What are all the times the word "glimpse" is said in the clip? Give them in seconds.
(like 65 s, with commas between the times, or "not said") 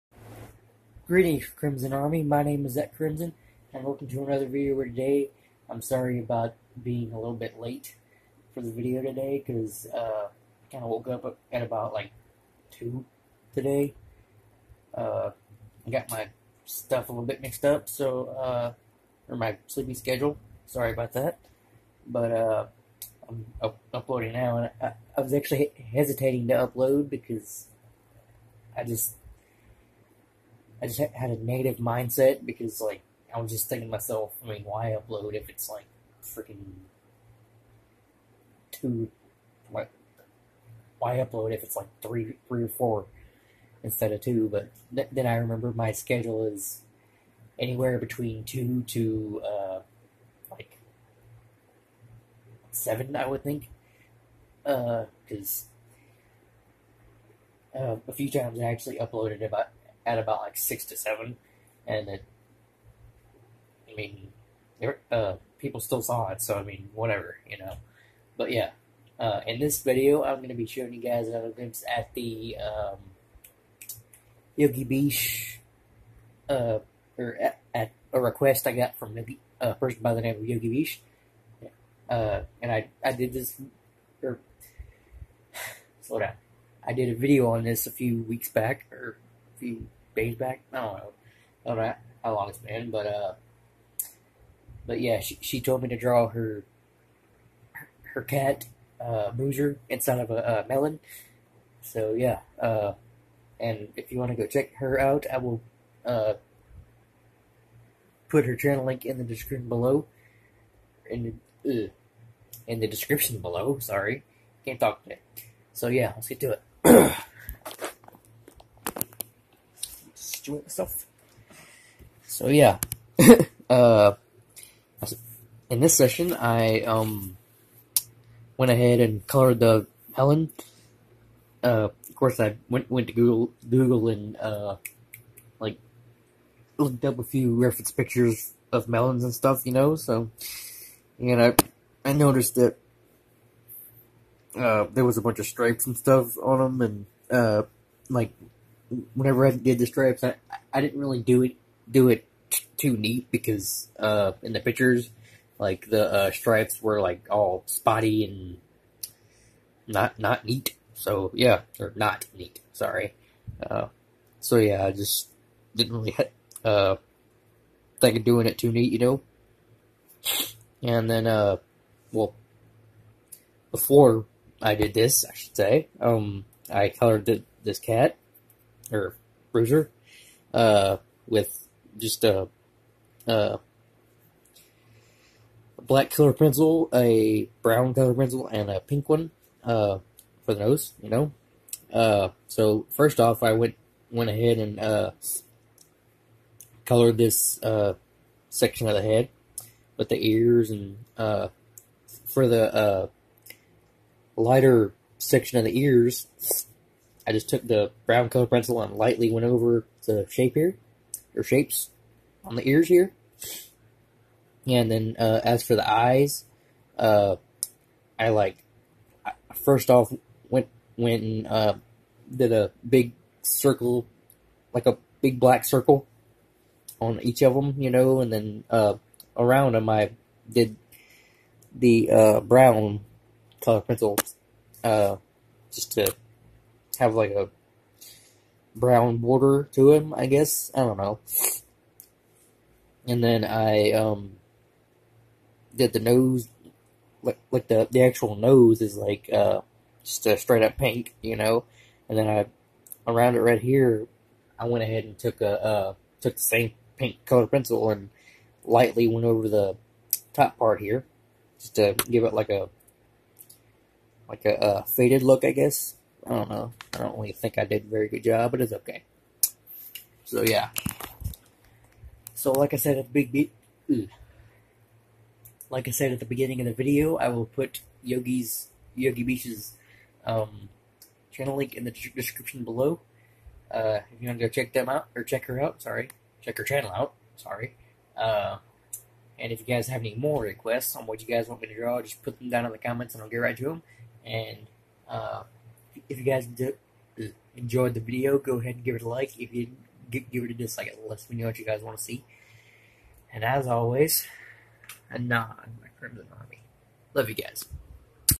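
71 s.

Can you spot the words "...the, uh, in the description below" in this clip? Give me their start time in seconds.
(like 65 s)
111 s.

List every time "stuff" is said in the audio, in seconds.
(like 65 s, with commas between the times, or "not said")
16 s, 139 s, 145 s.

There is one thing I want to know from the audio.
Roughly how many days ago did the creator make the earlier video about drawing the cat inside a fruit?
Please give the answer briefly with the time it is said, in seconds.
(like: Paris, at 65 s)
50, at 89 s.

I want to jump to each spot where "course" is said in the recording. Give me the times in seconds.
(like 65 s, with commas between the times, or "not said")
132 s.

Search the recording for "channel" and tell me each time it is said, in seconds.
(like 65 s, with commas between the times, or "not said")
108 s, 281 s, 286 s.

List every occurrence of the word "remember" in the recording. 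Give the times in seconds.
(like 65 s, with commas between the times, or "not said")
45 s.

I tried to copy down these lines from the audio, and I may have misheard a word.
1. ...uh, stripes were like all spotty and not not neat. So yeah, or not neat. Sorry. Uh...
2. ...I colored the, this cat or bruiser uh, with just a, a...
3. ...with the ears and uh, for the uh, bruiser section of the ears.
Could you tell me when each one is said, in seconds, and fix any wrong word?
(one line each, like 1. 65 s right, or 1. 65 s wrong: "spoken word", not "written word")
1. 156 s right
2. 176 s right
3. 199 s wrong: "lighter", not "bruiser".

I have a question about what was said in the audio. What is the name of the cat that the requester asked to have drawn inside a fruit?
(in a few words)
Boozer.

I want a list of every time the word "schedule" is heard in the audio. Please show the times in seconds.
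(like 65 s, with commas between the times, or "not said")
19 s, 45 s.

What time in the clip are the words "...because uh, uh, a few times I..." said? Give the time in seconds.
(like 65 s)
54 s.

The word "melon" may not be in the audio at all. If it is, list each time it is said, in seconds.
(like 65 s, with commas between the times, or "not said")
100 s, 138 s.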